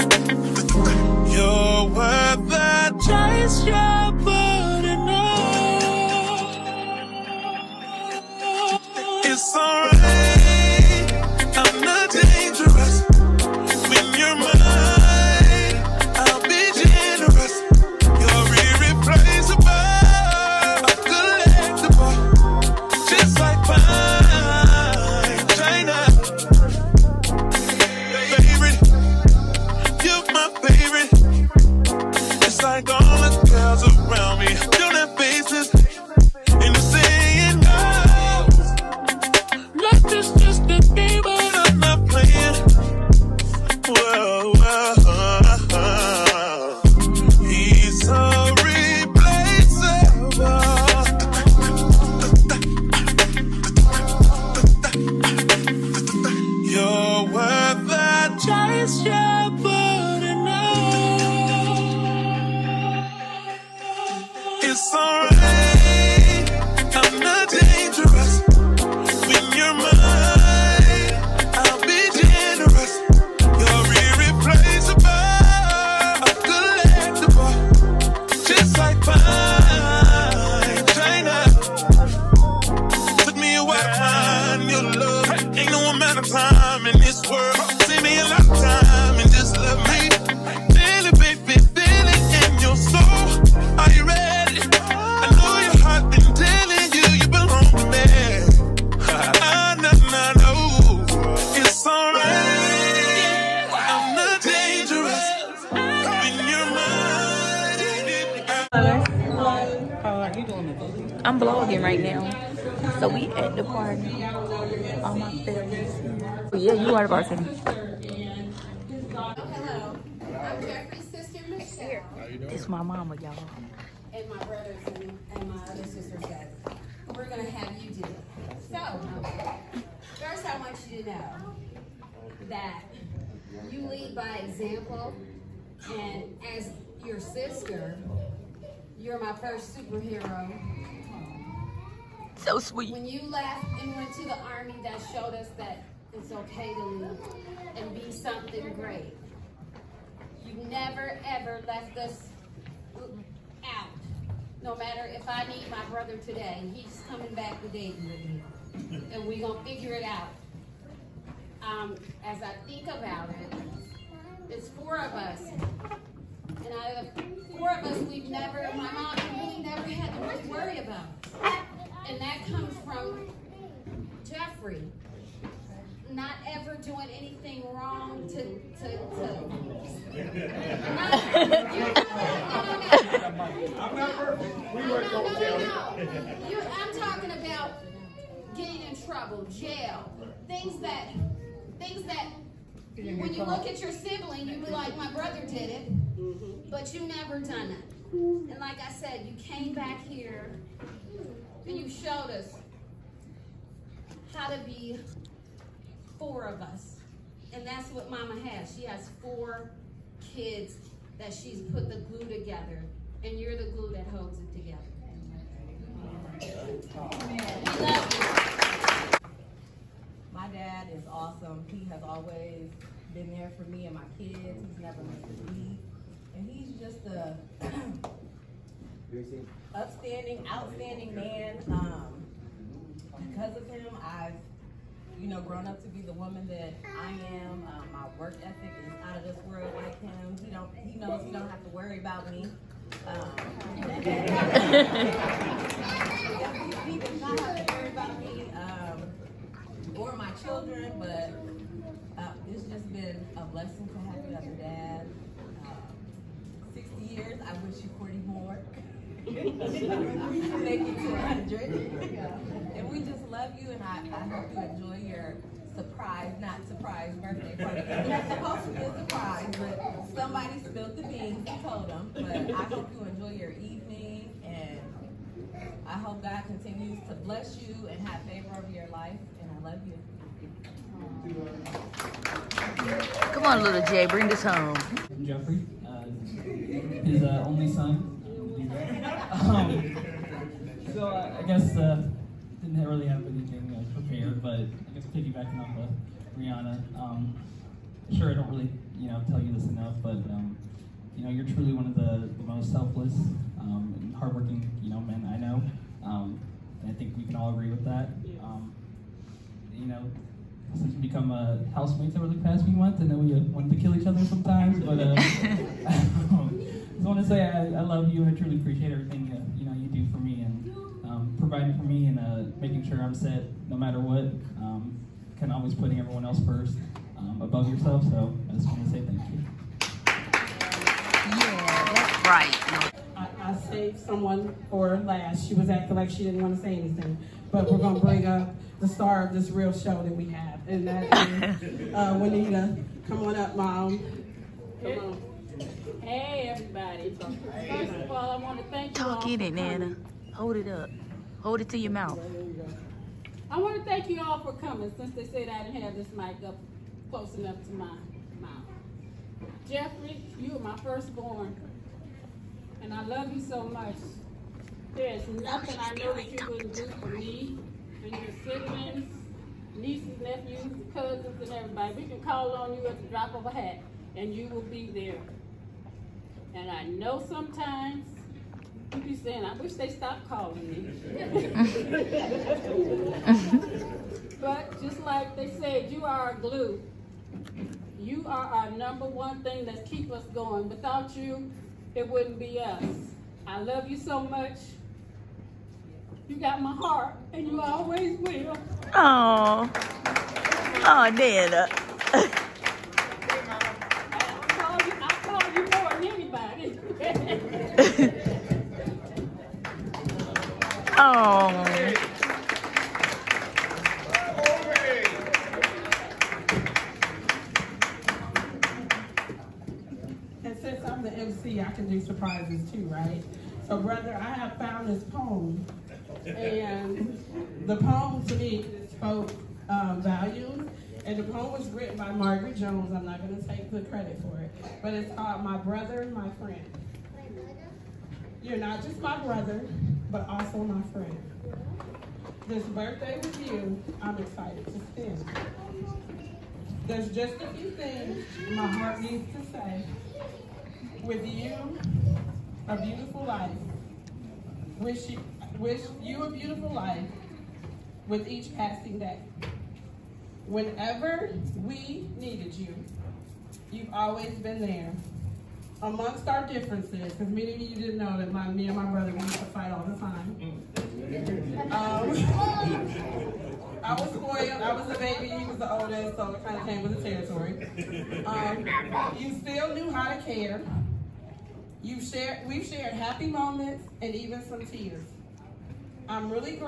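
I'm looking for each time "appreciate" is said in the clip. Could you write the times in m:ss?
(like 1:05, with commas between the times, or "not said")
5:18.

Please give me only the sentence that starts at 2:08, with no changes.
So, first I want you to know that you lead by example.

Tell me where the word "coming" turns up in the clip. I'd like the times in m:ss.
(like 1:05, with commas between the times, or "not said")
2:37, 5:54.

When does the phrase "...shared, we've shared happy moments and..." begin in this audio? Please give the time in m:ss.
8:02.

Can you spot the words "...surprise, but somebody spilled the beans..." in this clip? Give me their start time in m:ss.
4:28.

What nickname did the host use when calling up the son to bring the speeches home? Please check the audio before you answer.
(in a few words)
little Jay.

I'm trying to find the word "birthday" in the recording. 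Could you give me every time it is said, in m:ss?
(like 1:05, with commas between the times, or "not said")
4:27, 7:22.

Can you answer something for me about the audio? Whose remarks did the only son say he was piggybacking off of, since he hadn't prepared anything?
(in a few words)
Rihanna.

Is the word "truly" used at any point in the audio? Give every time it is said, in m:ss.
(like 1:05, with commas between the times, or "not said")
5:01, 5:18.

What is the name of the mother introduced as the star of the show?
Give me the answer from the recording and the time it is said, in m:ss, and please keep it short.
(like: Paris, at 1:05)
Juanita, at 5:42.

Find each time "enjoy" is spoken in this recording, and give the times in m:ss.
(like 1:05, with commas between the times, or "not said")
4:24, 4:33.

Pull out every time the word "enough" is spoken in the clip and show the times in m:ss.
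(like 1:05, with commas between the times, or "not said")
4:59, 5:57.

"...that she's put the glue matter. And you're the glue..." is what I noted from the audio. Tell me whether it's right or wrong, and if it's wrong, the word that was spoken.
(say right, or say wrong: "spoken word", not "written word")
wrong: "together", not "matter".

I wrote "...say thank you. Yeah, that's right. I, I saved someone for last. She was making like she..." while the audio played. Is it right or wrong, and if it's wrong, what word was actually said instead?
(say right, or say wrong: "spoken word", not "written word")
wrong: "acting", not "making".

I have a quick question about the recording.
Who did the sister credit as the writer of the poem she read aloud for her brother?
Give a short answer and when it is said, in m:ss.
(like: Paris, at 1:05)
Margaret Jones, at 7:12.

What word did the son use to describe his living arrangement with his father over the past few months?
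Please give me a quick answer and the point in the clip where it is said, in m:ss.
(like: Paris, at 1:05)
housemates, at 5:11.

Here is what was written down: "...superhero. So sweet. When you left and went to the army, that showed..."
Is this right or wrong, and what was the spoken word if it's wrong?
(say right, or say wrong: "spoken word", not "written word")
right.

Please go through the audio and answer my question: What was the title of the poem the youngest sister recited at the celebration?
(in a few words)
My Brother, My Friend.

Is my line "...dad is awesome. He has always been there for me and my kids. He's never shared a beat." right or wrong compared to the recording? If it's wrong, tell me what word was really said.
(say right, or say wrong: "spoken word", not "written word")
wrong: "missed", not "shared".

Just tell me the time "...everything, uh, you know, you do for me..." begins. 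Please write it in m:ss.
5:18.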